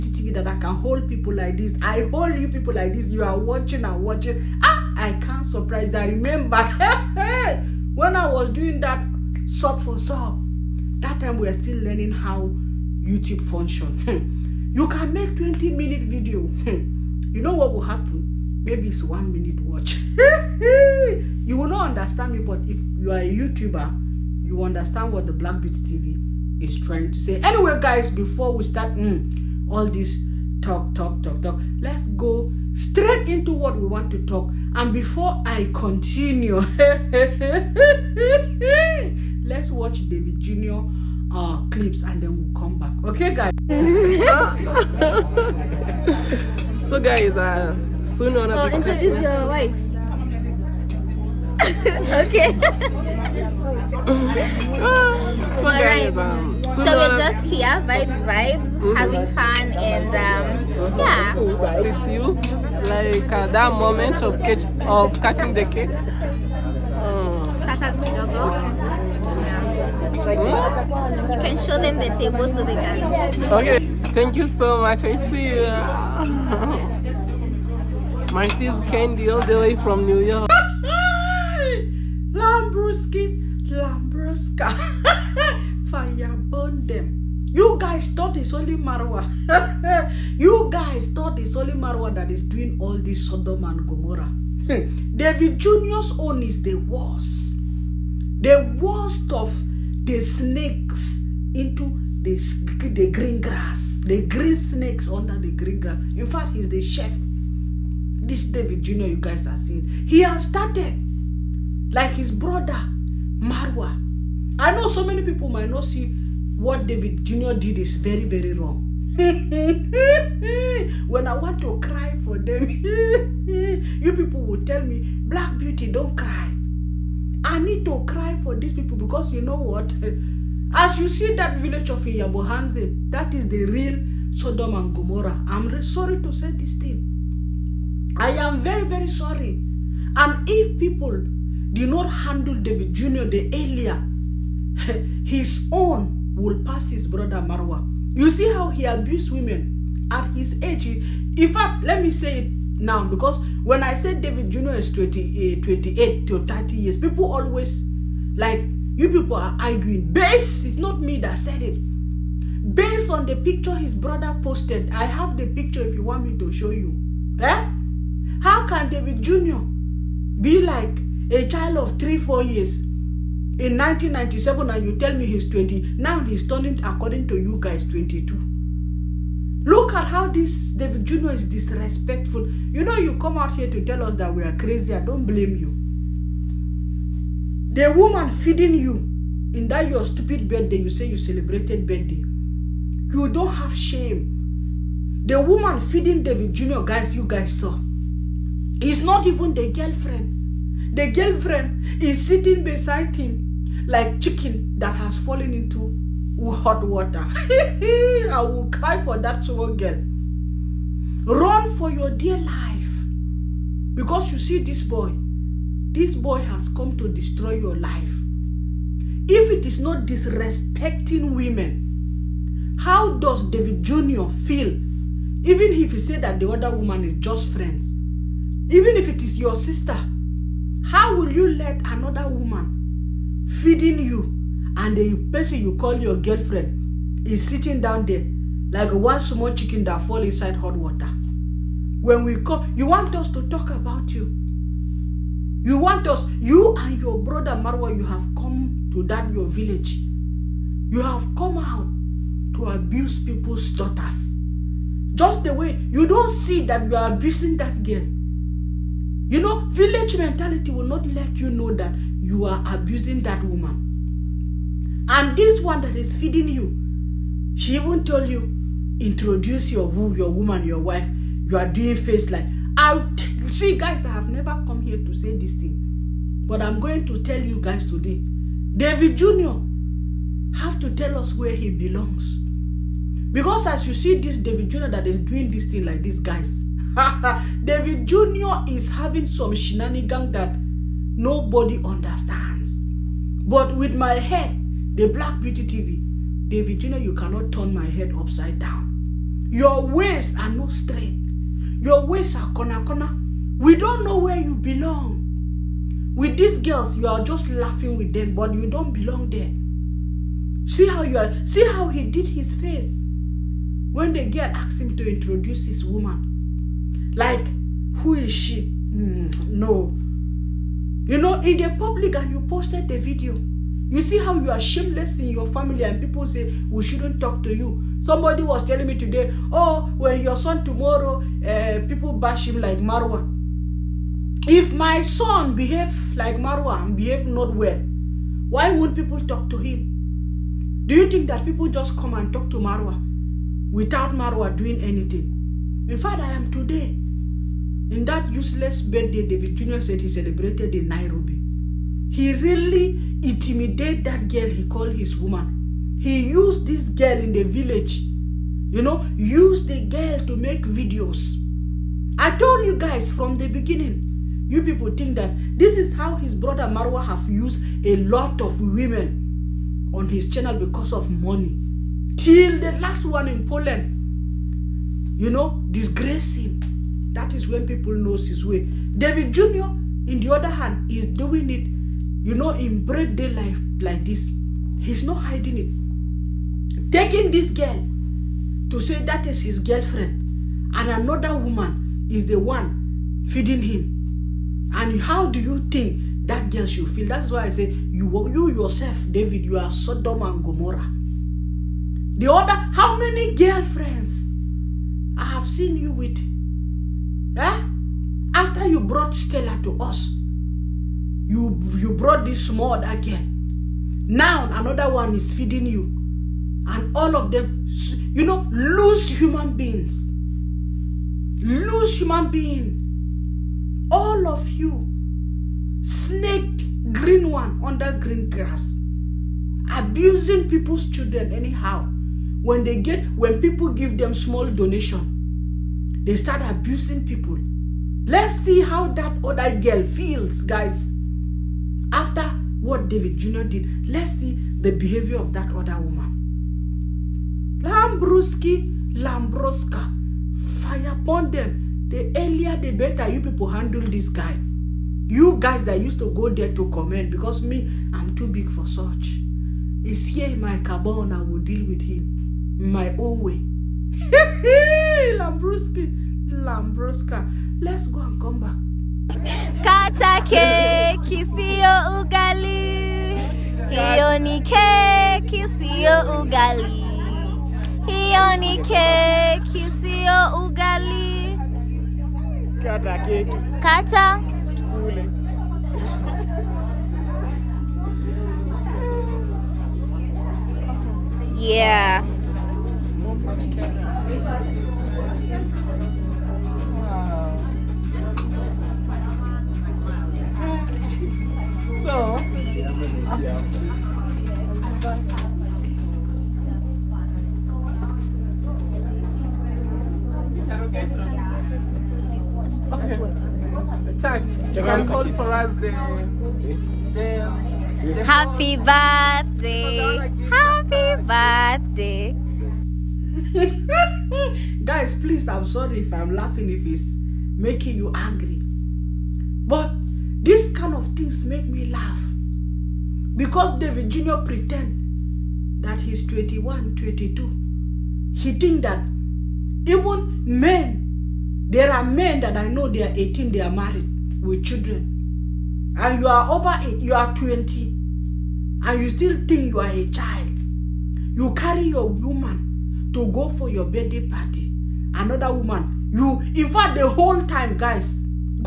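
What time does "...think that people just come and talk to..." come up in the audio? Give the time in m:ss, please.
5:41.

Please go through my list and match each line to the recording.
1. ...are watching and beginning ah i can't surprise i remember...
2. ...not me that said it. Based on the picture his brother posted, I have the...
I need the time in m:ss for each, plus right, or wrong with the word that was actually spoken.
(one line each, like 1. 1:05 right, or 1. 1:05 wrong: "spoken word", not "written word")
1. 0:03 wrong: "watching", not "beginning"
2. 2:40 right.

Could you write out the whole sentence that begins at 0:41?
Uh, clips and then we'll come back.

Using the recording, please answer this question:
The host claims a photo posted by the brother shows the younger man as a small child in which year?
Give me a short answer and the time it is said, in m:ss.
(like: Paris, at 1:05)
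1997, at 2:53.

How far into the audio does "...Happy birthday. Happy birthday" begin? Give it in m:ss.
8:38.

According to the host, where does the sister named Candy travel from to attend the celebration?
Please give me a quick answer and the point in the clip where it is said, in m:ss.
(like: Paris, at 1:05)
New York, at 1:20.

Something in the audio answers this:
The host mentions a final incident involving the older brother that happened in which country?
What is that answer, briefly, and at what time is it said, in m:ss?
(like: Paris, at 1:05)
Poland, at 6:13.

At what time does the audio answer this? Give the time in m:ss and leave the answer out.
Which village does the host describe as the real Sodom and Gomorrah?
2:12.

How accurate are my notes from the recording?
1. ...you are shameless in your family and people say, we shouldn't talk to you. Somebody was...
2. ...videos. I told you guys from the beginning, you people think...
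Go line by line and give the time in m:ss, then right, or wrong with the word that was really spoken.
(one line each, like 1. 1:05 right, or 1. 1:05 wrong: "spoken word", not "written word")
1. 5:24 right
2. 6:00 right.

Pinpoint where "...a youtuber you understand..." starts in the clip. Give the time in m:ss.
0:23.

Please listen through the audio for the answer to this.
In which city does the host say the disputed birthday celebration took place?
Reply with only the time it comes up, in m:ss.
5:50.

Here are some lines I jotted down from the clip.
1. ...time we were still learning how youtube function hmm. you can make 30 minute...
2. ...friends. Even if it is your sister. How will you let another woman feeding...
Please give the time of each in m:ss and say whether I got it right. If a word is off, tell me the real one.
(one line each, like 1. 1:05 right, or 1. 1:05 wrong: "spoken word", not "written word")
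1. 0:11 wrong: "20", not "30"
2. 3:47 right.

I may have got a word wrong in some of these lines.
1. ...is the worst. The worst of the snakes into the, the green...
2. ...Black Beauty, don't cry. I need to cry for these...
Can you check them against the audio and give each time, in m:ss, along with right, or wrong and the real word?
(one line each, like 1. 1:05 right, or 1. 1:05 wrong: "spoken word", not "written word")
1. 1:36 right
2. 2:05 right.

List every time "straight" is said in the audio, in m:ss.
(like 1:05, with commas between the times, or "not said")
0:32, 5:00.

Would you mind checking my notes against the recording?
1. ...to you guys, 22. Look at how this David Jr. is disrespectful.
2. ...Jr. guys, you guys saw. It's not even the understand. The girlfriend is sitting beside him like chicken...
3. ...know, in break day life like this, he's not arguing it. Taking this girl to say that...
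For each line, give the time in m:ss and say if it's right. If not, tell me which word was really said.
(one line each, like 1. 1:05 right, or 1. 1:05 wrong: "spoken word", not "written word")
1. 2:57 right
2. 3:16 wrong: "girlfriend", not "understand"
3. 6:22 wrong: "hiding", not "arguing".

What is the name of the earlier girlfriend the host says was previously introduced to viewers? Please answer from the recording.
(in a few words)
Stella.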